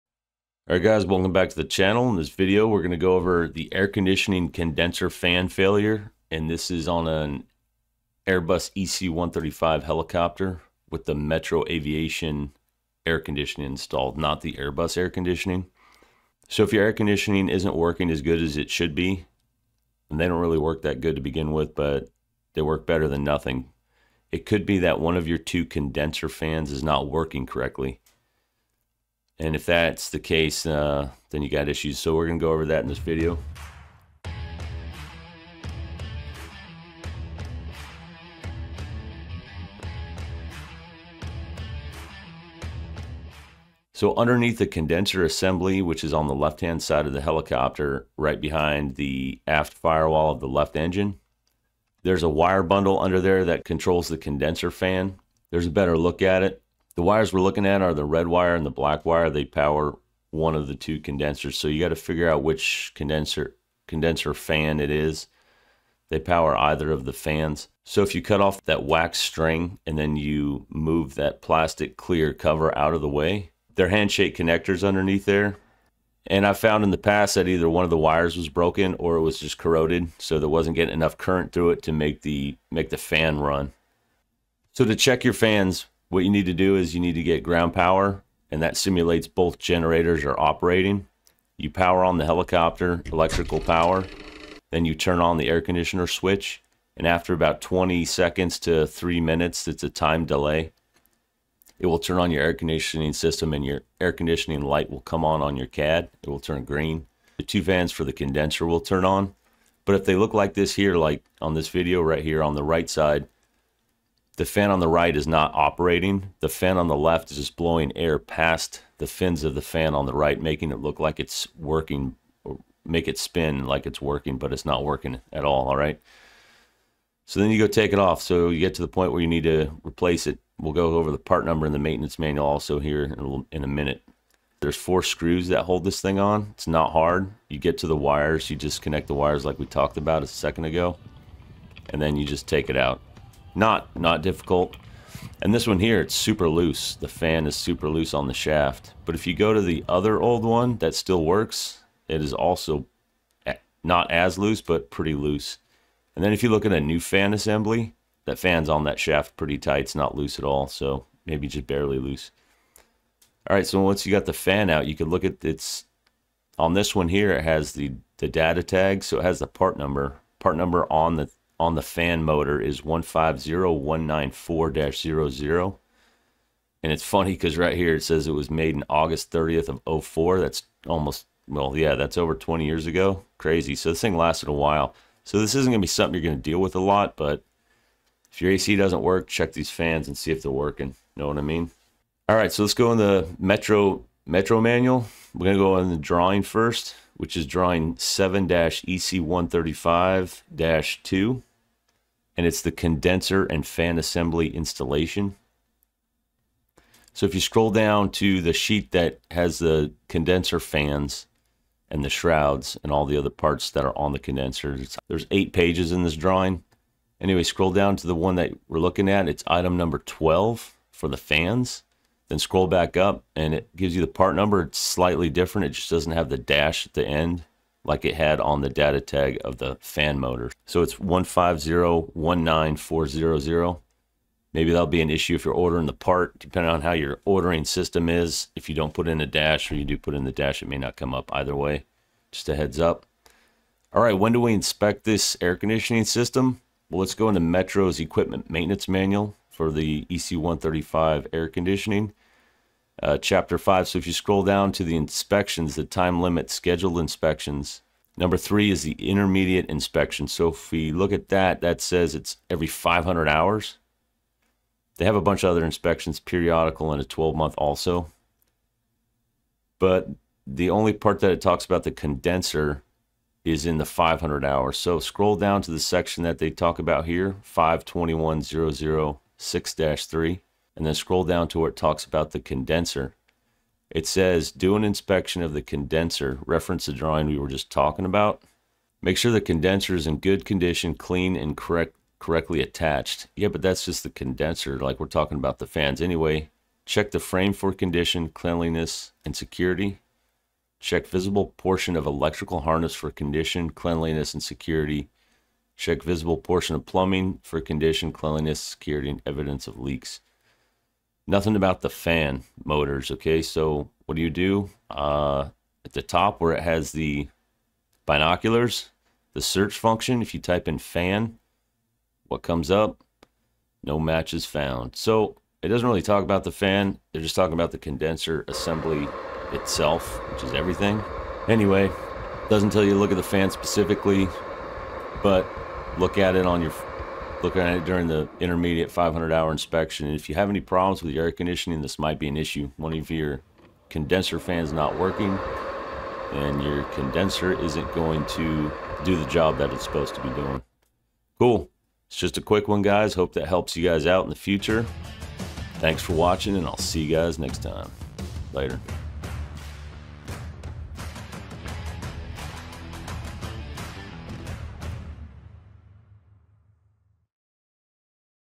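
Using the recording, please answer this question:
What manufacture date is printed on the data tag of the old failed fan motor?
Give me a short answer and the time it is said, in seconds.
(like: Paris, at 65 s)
August 30, 2004, at 178 s.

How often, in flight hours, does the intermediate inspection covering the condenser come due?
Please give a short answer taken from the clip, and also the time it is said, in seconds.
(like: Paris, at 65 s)
500 hours, at 262 s.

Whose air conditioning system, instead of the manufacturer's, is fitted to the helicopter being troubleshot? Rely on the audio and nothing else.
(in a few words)
Metro Aviation.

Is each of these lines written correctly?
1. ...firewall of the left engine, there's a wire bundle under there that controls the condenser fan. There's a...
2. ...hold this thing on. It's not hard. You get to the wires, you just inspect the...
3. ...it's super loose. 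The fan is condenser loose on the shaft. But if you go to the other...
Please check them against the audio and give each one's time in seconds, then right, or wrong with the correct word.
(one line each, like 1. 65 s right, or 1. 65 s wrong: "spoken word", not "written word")
1. 49 s right
2. 135 s wrong: "connect", not "inspect"
3. 146 s wrong: "super", not "condenser".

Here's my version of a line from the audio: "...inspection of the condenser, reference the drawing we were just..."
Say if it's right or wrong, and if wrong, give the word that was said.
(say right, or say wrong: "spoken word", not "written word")
right.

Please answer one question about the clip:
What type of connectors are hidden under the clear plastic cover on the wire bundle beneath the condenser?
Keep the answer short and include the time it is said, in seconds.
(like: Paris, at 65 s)
Handshake connectors, at 73 s.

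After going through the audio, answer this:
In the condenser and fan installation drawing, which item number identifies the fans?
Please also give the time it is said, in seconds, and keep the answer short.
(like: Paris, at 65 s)
12, at 219 s.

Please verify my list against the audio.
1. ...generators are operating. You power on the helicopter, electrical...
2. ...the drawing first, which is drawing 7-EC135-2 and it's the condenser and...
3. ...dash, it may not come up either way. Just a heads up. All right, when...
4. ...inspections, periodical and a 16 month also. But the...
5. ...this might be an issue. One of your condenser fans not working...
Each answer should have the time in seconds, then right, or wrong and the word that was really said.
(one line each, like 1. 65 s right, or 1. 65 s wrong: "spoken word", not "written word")
1. 89 s right
2. 195 s right
3. 240 s right
4. 265 s wrong: "12", not "16"
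5. 341 s right.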